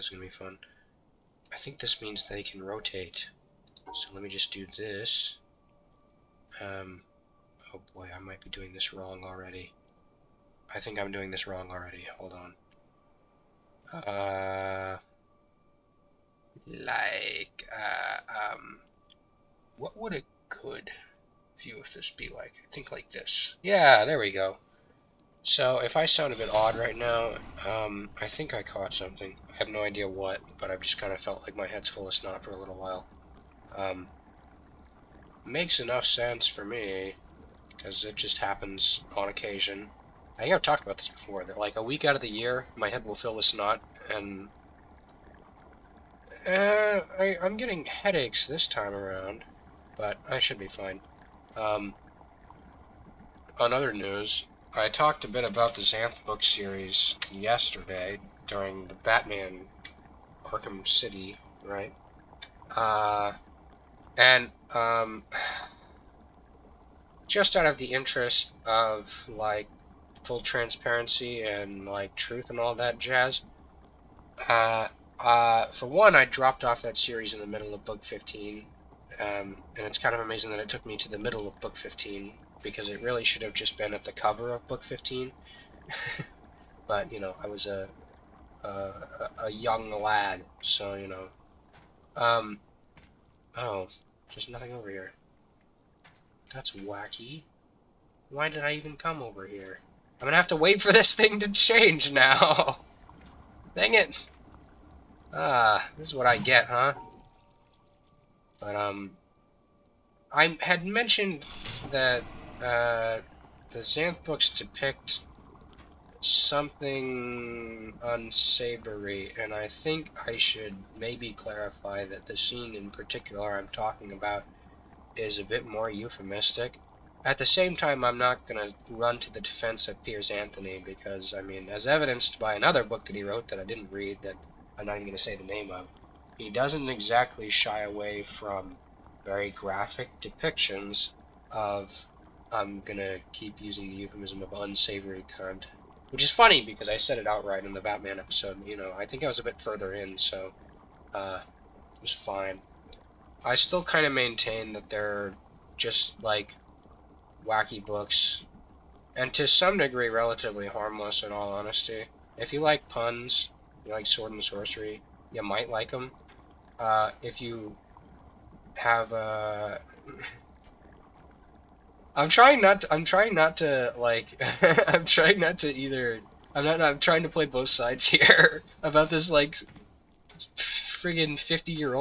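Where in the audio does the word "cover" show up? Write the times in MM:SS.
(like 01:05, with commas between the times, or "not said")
01:24.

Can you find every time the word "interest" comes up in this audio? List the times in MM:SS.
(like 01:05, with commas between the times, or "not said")
01:07.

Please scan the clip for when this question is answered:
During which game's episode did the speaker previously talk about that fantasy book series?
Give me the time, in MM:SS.
00:58.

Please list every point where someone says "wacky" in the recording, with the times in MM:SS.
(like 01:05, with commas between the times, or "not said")
01:36, 02:37.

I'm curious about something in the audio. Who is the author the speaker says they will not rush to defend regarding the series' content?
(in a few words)
Piers Anthony.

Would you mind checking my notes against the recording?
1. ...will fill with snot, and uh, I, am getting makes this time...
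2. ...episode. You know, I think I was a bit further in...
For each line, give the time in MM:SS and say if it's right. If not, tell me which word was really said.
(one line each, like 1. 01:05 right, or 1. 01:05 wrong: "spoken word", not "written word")
1. 00:43 wrong: "headaches", not "makes"
2. 02:28 right.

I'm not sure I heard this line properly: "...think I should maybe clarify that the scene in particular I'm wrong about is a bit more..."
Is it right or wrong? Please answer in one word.
wrong.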